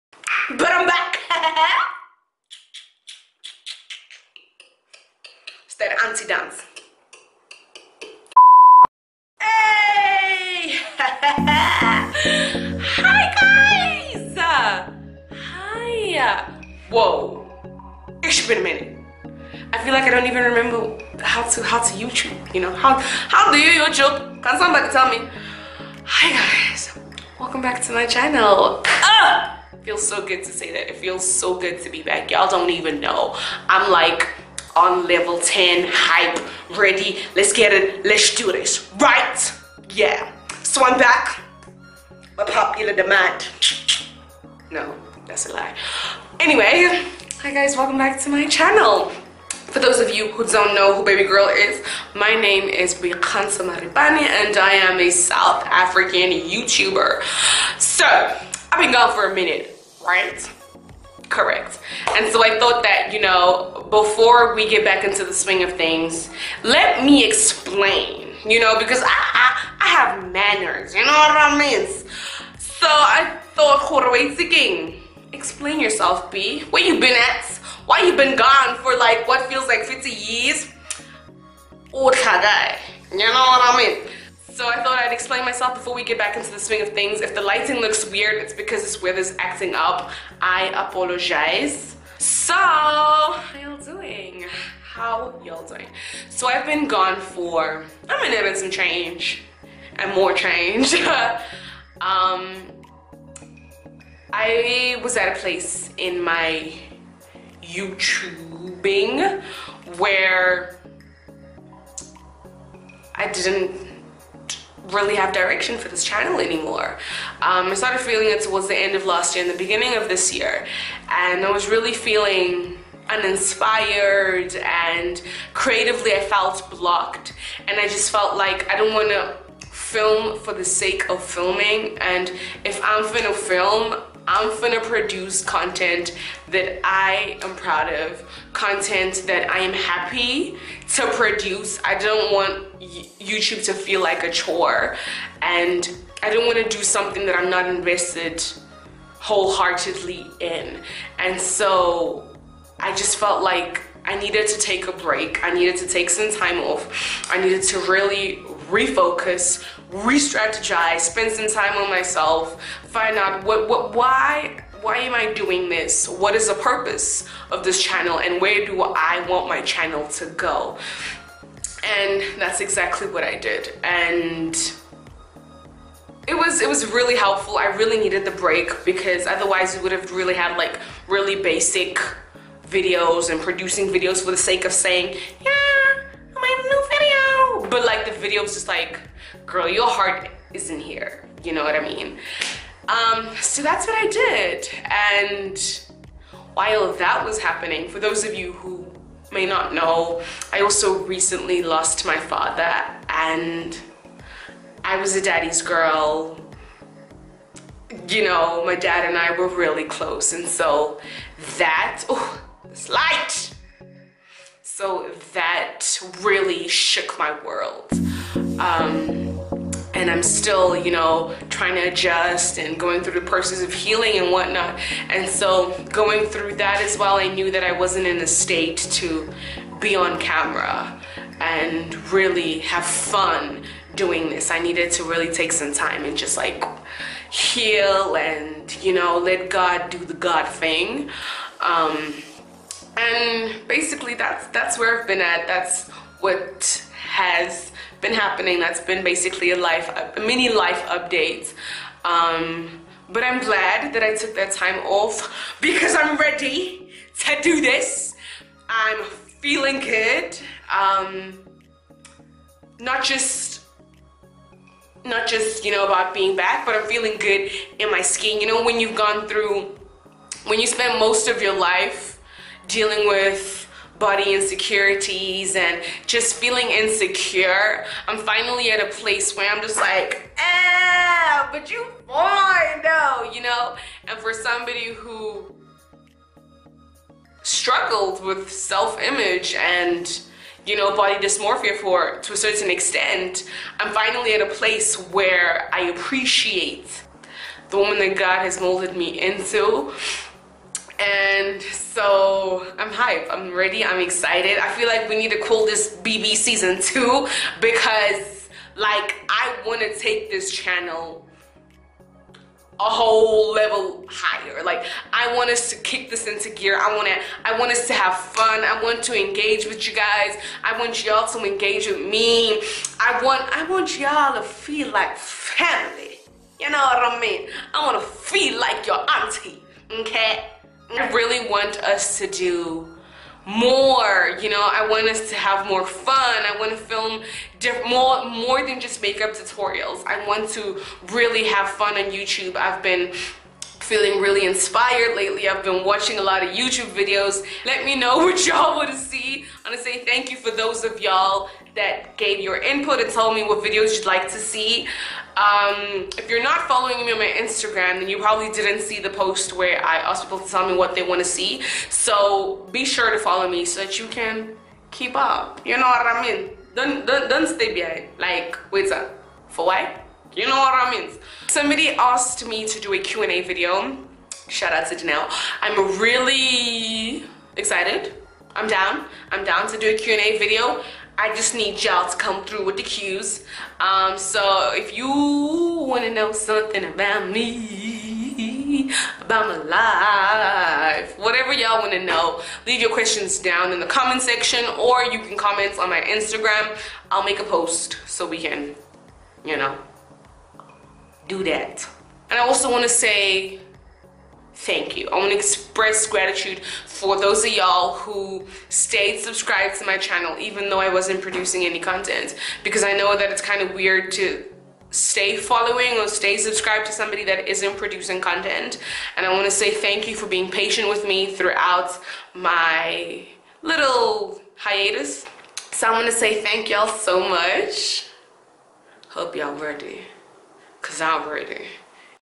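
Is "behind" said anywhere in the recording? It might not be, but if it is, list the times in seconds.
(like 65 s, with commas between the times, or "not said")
367 s.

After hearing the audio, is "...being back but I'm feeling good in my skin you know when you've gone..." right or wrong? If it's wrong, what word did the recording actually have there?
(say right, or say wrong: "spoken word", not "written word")
right.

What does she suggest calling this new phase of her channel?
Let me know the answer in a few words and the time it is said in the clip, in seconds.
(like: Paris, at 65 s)
BB season two, at 305 s.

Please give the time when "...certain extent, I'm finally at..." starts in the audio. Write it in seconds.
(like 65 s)
292 s.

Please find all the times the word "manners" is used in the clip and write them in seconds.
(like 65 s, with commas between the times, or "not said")
70 s.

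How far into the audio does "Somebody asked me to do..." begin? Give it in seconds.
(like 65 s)
371 s.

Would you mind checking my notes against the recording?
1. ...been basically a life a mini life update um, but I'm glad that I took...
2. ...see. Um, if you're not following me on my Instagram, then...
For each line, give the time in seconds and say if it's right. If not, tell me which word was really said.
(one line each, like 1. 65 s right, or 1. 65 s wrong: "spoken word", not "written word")
1. 248 s right
2. 354 s right.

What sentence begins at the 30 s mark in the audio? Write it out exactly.
It feels so good to be back.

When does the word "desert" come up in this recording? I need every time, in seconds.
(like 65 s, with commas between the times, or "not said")
not said.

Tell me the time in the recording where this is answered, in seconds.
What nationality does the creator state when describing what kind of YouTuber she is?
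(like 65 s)
55 s.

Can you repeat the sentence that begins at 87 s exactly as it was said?
If the lighting looks weird, it's because this weather's acting up.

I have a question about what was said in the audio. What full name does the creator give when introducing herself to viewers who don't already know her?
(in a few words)
Bianca Maripane.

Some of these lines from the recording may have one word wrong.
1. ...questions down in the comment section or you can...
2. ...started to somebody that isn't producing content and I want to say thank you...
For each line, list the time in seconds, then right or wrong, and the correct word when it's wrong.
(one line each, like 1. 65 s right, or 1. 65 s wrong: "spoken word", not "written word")
1. 392 s right
2. 416 s wrong: "subscribed", not "started".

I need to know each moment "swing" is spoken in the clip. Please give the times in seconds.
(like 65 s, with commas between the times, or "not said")
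65 s, 86 s.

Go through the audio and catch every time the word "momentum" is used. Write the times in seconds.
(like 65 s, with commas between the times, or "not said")
not said.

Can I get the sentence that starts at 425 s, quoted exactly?
So I want to say thank y'all so much.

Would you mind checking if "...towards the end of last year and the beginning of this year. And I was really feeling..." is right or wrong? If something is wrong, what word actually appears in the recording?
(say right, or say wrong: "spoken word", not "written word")
right.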